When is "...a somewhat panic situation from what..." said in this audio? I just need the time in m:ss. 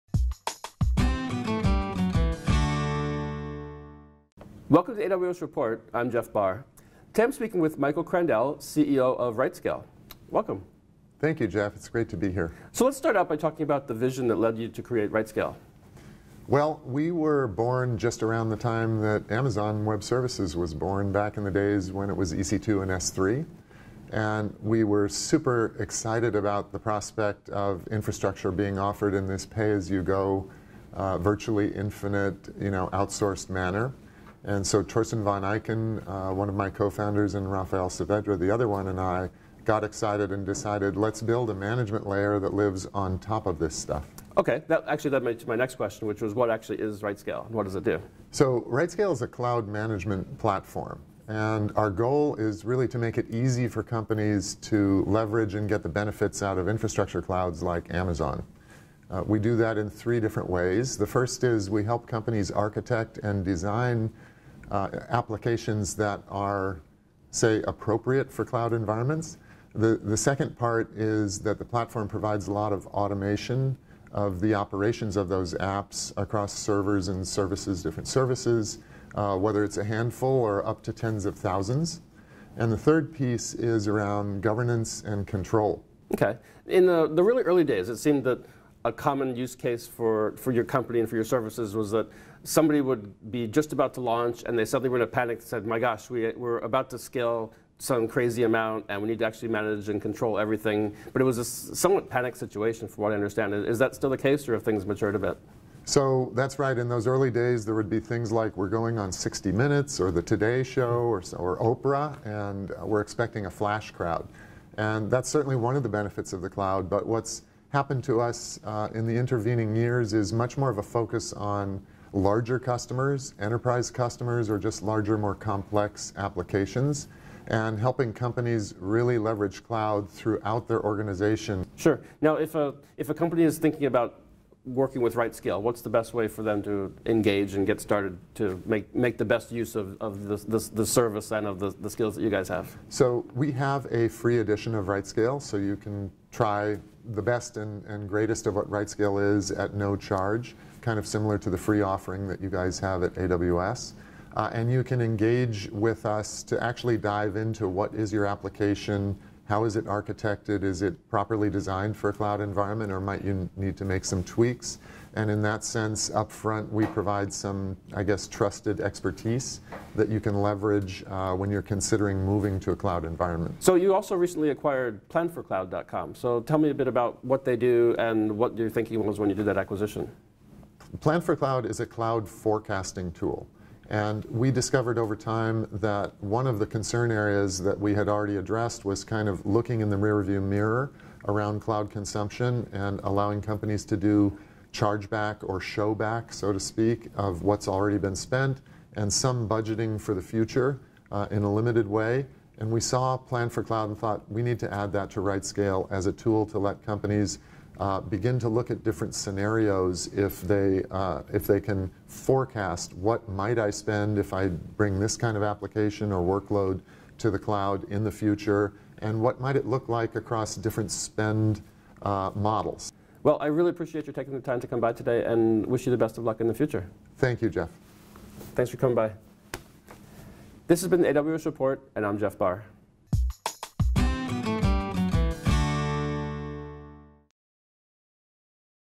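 1:41.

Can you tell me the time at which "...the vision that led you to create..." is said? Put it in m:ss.
0:13.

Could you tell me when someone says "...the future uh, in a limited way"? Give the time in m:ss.
3:20.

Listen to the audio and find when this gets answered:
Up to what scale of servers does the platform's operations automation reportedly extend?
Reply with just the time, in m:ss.
1:20.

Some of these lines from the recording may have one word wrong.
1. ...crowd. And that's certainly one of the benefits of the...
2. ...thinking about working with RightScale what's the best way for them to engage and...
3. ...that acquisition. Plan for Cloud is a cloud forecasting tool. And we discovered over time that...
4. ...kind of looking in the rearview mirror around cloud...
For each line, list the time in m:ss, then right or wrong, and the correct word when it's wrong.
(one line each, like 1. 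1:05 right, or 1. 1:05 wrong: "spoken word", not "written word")
1. 1:53 right
2. 2:13 right
3. 2:59 right
4. 3:09 right.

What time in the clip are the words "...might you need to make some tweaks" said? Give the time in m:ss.
2:43.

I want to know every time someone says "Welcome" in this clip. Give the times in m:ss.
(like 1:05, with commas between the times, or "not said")
0:04, 0:10.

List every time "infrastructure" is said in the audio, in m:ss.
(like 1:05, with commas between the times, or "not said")
0:27, 0:56.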